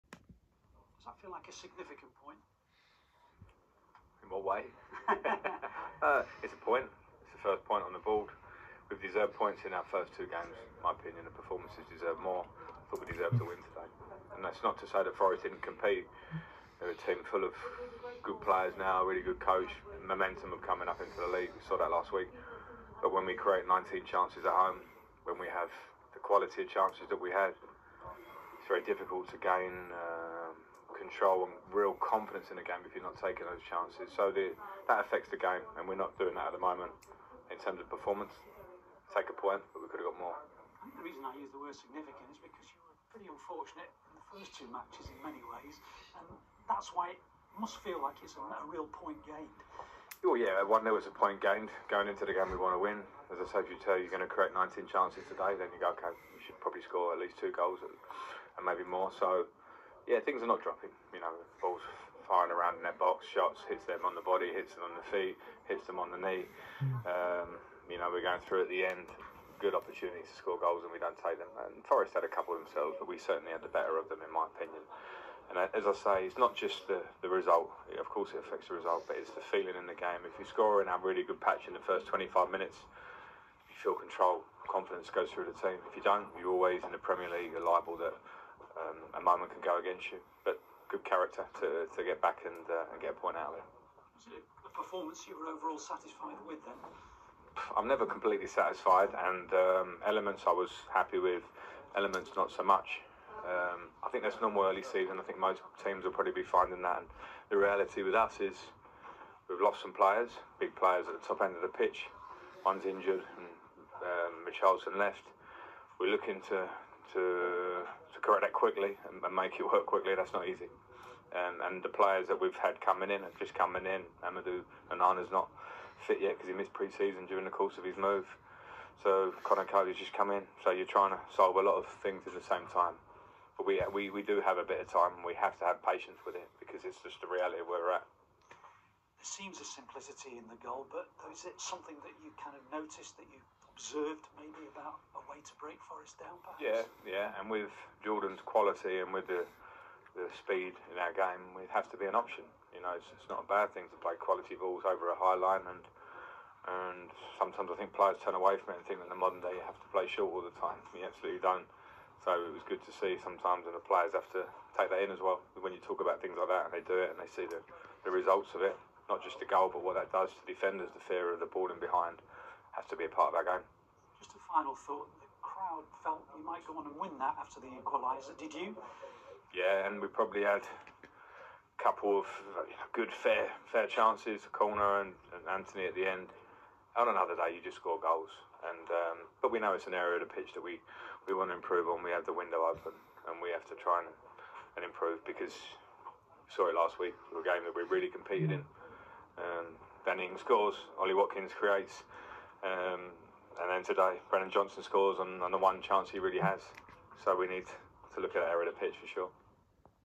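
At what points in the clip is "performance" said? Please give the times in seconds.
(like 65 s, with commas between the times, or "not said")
11 s, 37 s, 94 s.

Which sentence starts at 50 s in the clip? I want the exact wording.
Oh yeah, one there was a point gained going into the game.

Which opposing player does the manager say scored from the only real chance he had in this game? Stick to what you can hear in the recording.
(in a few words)
Brennan Johnson.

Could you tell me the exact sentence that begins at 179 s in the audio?
Yeah, and we probably had a couple of good, fair, fair chances, corner and, and Anthony at the end.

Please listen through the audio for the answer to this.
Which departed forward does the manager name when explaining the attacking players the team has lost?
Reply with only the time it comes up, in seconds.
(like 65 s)
114 s.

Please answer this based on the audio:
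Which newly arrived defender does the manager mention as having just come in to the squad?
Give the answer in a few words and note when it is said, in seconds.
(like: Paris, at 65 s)
Conor Coady, at 129 s.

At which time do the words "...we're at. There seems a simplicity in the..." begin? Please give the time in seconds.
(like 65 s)
137 s.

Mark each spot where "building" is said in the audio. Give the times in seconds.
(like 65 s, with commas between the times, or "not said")
not said.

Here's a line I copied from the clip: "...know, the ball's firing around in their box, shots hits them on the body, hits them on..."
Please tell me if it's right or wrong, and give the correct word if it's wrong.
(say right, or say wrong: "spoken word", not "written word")
right.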